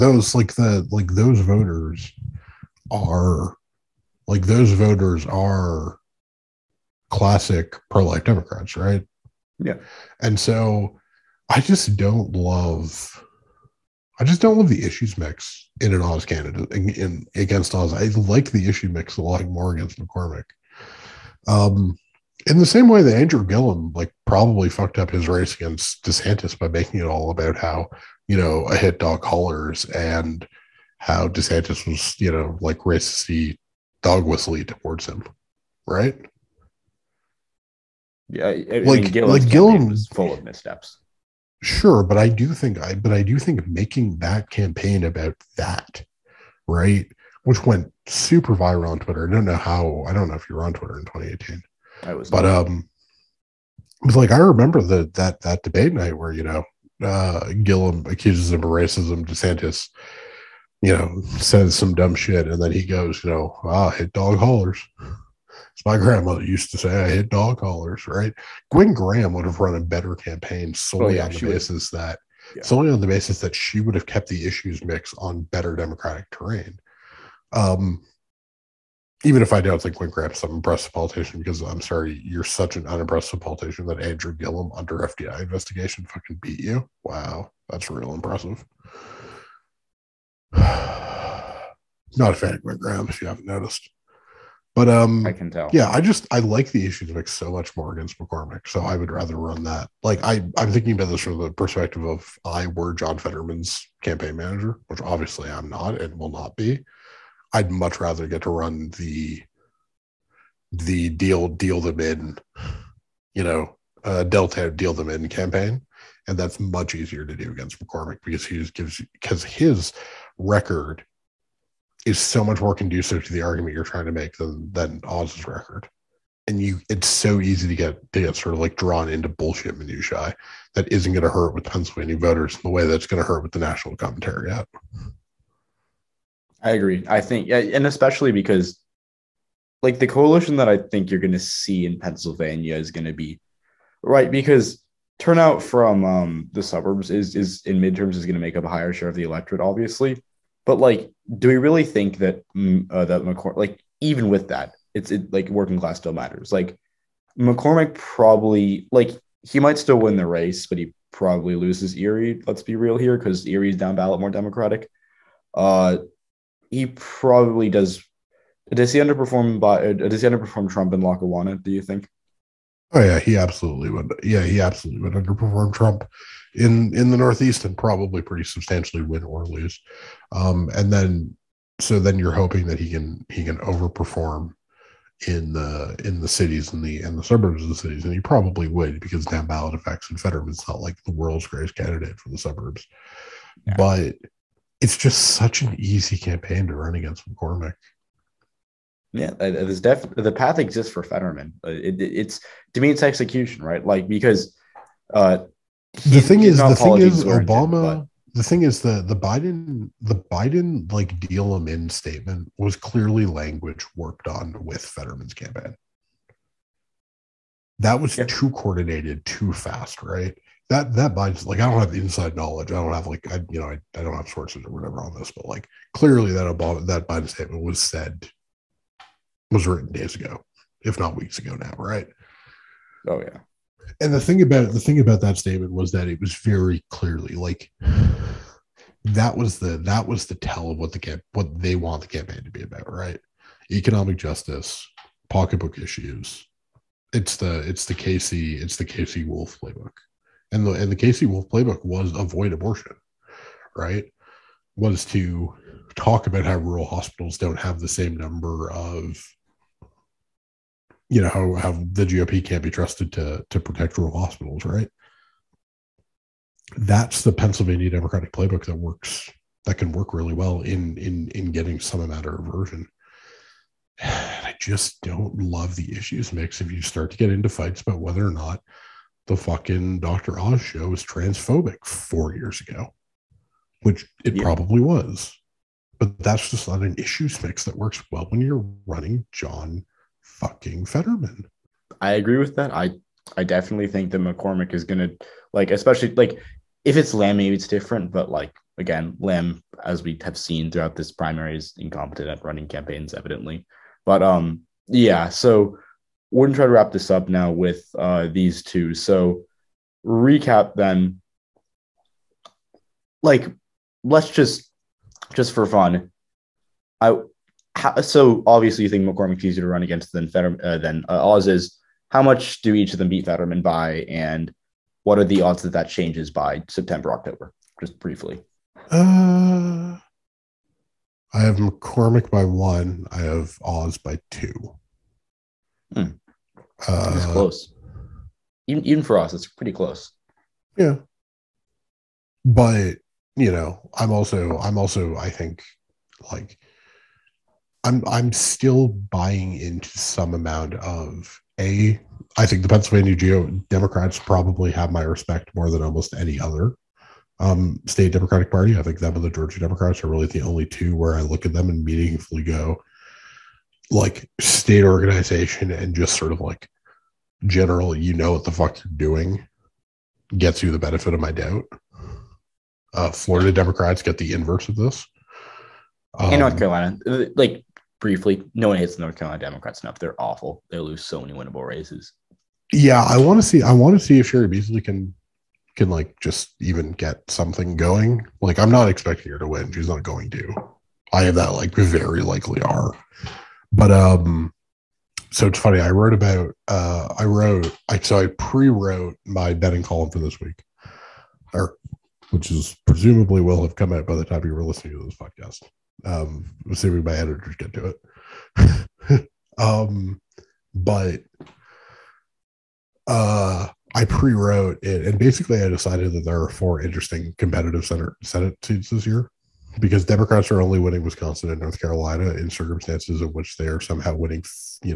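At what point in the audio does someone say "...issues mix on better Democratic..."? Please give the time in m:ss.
1:14.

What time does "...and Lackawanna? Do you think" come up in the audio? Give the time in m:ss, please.
2:50.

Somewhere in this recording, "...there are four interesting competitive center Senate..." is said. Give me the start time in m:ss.
6:56.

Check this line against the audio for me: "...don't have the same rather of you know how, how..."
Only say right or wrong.
wrong.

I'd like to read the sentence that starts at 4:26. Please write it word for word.
That's the Pennsylvania Democratic playbook that works that can work really well in in in getting some amount of aversion.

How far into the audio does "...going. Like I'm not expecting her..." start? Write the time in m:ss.
6:27.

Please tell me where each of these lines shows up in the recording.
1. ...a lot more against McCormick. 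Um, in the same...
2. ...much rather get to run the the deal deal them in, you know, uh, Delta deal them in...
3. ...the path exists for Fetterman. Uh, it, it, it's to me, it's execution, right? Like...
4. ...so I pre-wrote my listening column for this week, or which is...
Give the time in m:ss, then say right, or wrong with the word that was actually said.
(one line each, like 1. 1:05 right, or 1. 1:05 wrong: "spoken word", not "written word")
1. 0:19 right
2. 1:47 right
3. 3:20 right
4. 6:37 wrong: "betting", not "listening".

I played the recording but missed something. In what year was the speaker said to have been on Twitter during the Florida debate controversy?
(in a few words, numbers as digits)
2018.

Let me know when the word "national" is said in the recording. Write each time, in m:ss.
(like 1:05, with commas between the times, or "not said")
2:13.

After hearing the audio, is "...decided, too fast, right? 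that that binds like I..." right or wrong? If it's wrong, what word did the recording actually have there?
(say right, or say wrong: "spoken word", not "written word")
wrong: "coordinated", not "decided".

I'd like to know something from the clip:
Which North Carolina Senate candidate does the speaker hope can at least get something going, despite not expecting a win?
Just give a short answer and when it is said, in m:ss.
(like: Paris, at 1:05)
Cheri Beasley, at 6:24.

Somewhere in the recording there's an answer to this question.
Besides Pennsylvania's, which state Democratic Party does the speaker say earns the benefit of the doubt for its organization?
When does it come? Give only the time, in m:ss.
5:59.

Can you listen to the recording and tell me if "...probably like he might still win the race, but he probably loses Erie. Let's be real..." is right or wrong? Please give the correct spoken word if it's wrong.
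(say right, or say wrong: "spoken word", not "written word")
right.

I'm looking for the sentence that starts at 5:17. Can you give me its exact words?
I how, so obviously you think McCormick's easier to run against than Fetterman uh, than uh, Oz is.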